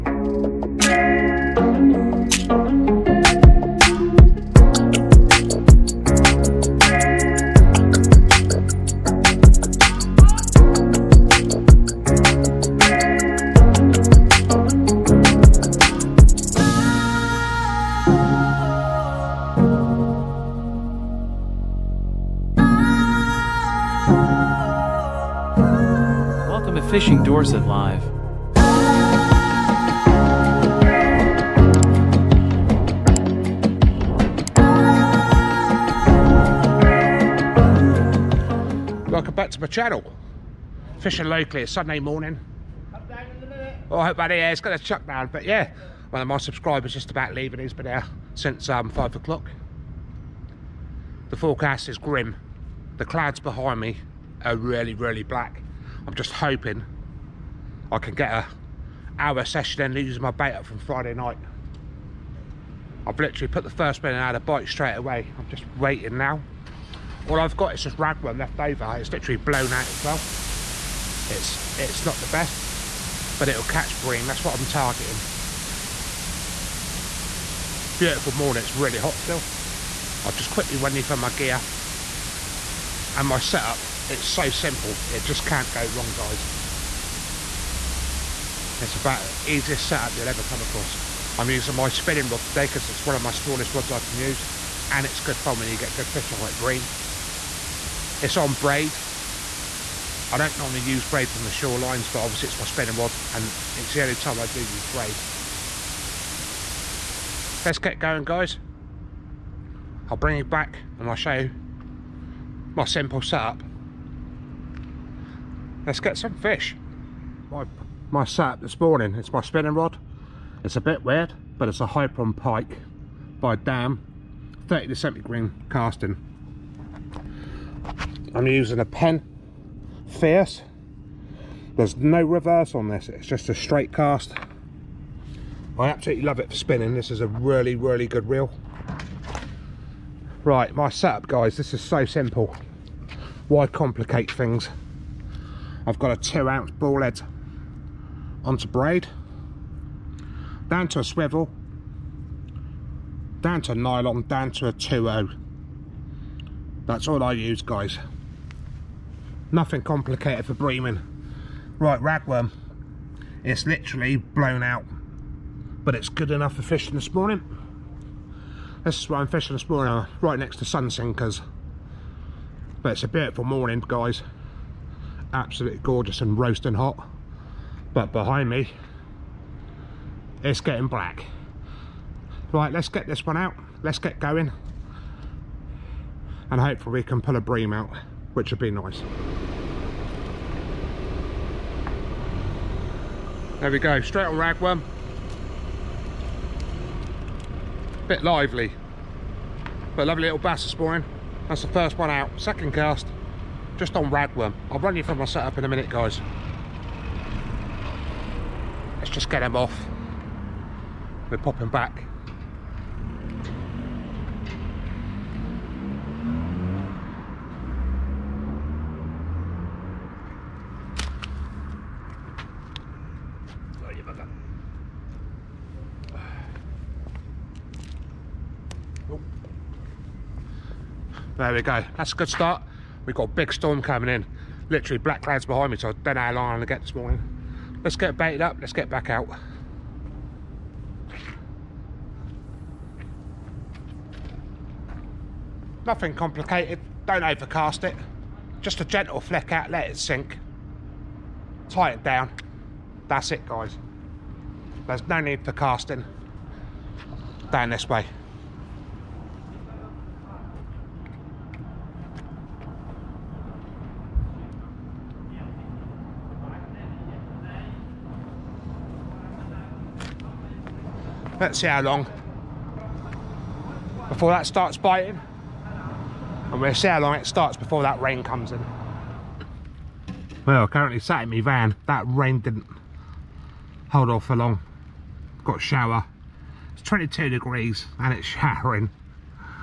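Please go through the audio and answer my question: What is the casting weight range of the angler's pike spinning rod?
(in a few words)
30 to 70 gram.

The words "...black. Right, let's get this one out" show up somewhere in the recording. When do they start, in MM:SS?
03:00.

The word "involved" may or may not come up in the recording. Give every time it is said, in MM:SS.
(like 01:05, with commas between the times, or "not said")
not said.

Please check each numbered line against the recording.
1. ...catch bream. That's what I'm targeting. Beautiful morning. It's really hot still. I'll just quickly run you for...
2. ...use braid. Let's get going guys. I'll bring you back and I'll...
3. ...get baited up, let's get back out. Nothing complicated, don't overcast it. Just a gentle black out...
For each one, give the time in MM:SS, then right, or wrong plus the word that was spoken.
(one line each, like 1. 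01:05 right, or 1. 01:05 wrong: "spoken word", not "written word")
1. 01:13 right
2. 01:44 right
3. 03:57 wrong: "flick", not "black".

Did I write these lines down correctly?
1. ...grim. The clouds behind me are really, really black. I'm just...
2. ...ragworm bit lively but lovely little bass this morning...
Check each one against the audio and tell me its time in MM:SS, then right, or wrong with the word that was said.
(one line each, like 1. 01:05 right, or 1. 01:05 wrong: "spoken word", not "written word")
1. 00:51 right
2. 03:14 right.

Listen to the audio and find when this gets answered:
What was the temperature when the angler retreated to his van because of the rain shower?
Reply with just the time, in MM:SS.
04:46.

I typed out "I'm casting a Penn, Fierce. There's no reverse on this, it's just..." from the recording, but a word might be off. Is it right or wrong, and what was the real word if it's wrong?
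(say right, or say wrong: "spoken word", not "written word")
wrong: "using", not "casting".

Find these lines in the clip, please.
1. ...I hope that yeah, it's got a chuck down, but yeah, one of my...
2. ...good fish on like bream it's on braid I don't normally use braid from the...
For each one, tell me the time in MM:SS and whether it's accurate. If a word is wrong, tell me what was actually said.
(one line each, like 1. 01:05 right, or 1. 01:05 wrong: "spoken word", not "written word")
1. 00:43 right
2. 01:35 right.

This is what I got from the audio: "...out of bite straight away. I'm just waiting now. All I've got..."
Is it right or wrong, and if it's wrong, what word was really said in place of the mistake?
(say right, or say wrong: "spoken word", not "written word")
right.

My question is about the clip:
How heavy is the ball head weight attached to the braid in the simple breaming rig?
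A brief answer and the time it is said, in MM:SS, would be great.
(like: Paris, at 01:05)
2 ounce, at 02:26.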